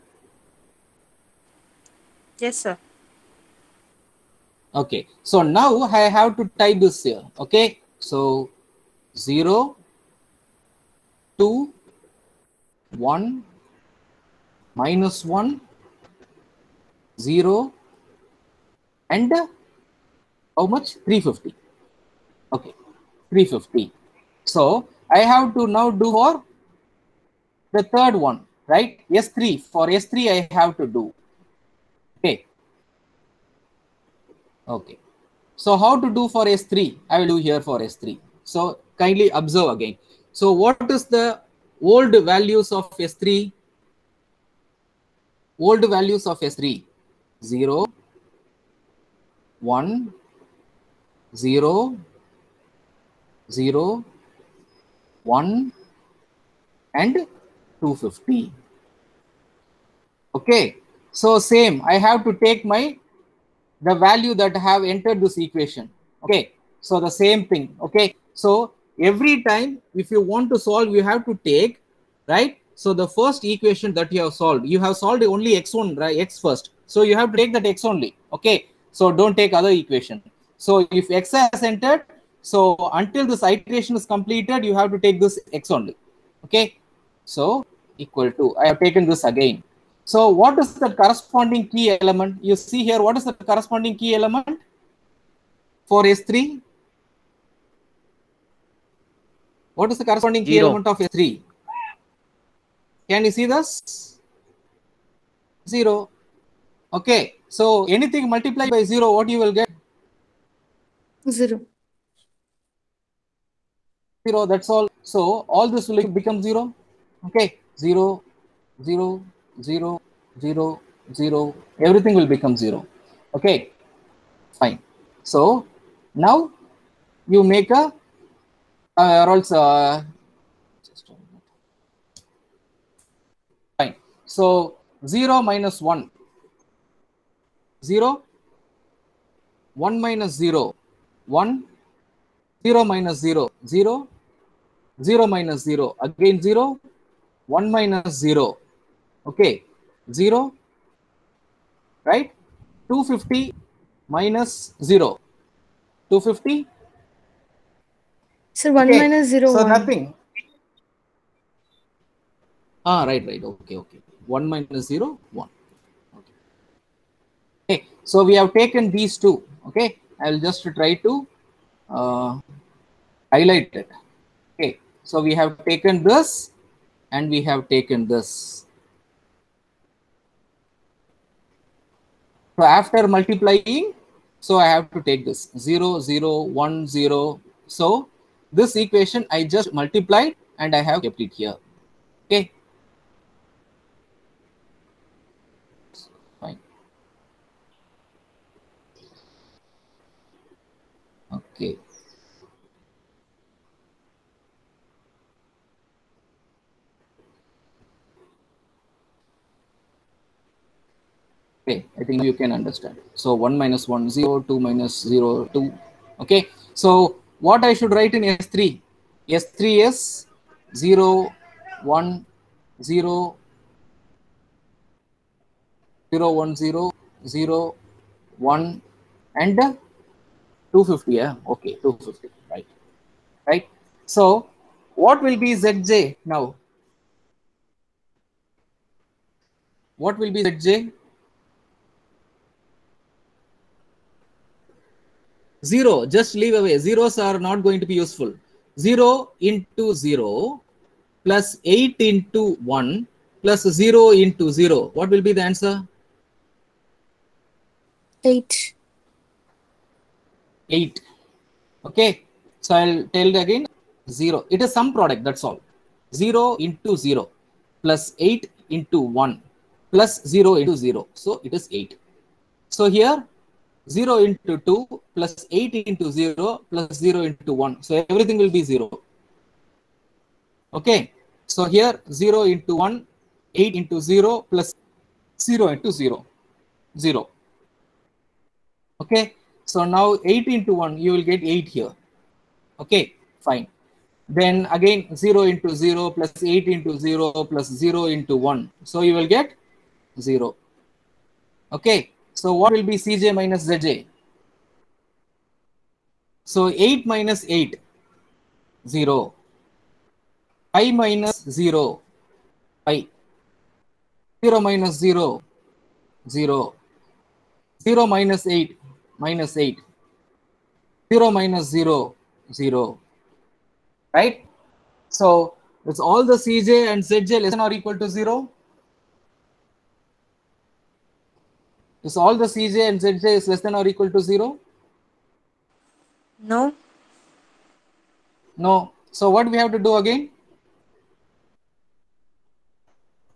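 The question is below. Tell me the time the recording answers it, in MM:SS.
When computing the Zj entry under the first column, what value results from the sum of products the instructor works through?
04:31.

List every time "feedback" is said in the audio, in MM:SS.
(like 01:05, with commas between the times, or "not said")
not said.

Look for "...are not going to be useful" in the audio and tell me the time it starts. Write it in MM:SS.
04:07.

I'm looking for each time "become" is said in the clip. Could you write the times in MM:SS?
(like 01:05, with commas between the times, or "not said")
01:56, 02:02.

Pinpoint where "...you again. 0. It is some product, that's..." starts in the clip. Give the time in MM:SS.
04:23.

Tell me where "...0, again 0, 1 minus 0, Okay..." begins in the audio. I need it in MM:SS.
02:25.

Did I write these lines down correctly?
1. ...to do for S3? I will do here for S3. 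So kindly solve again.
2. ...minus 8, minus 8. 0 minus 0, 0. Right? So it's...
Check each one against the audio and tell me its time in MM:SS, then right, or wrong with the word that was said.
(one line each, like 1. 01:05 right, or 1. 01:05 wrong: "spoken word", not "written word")
1. 00:36 wrong: "observe", not "solve"
2. 05:18 right.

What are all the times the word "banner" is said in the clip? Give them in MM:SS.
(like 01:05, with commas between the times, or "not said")
not said.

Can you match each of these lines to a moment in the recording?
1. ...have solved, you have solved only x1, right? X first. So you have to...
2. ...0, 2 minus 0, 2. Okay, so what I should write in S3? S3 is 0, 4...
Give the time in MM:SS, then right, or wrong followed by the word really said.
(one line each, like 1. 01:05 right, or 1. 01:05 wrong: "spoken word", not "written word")
1. 01:14 right
2. 03:34 wrong: "1", not "4".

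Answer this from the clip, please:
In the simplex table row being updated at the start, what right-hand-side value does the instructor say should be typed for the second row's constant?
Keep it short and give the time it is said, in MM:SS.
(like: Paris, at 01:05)
350, at 00:20.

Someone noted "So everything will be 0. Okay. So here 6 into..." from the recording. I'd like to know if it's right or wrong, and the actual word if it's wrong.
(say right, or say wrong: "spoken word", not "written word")
wrong: "0", not "6".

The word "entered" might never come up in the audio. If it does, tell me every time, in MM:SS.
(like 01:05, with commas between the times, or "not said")
01:04, 01:21.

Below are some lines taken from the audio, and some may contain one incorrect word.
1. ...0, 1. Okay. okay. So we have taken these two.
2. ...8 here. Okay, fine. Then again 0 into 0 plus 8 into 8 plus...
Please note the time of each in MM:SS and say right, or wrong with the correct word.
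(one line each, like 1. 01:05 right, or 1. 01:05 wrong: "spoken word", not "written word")
1. 02:44 right
2. 04:51 wrong: "0", not "8".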